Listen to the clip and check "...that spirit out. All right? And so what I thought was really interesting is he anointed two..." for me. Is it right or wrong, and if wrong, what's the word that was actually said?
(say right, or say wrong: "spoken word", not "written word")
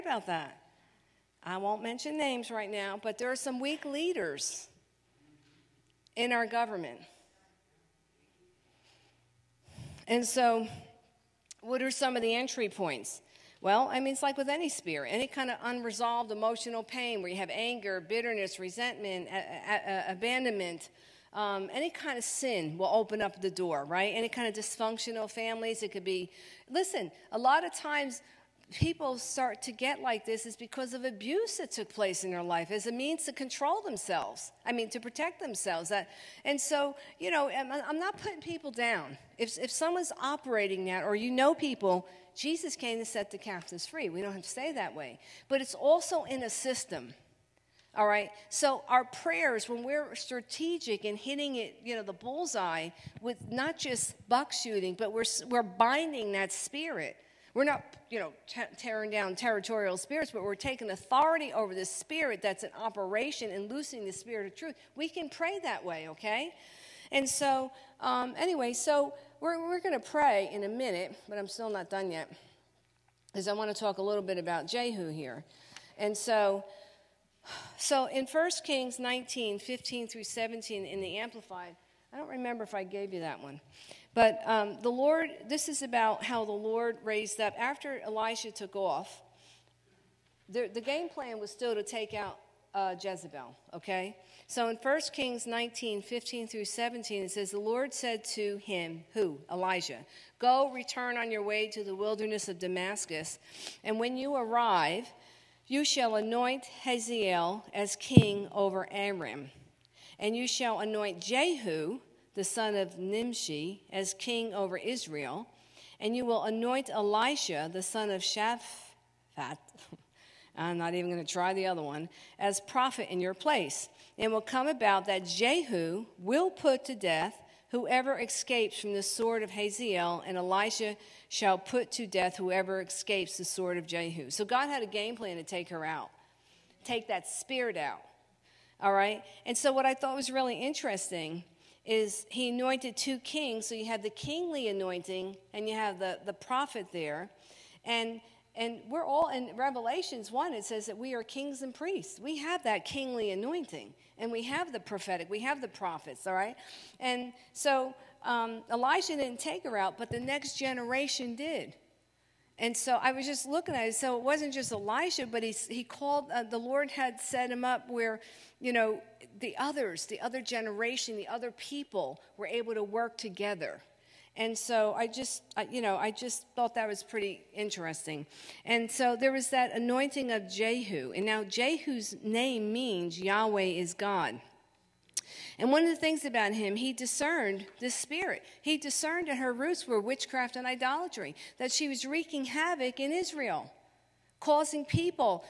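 right.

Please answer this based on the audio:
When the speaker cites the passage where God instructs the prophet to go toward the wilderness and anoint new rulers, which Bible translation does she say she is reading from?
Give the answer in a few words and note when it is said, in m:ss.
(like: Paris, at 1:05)
Amplified, at 1:21.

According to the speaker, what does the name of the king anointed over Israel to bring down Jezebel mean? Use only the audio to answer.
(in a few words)
Yahweh is God.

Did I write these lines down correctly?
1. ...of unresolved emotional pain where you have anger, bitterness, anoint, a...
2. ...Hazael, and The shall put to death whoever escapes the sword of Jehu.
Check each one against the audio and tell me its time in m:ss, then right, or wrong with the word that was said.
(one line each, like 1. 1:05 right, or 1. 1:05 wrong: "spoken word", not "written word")
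1. 0:15 wrong: "resentment", not "anoint"
2. 2:09 wrong: "Elisha", not "The".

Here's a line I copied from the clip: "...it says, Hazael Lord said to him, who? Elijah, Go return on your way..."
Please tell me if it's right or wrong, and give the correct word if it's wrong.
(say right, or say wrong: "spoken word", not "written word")
wrong: "The", not "Hazael".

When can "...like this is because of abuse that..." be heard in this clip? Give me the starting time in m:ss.
0:30.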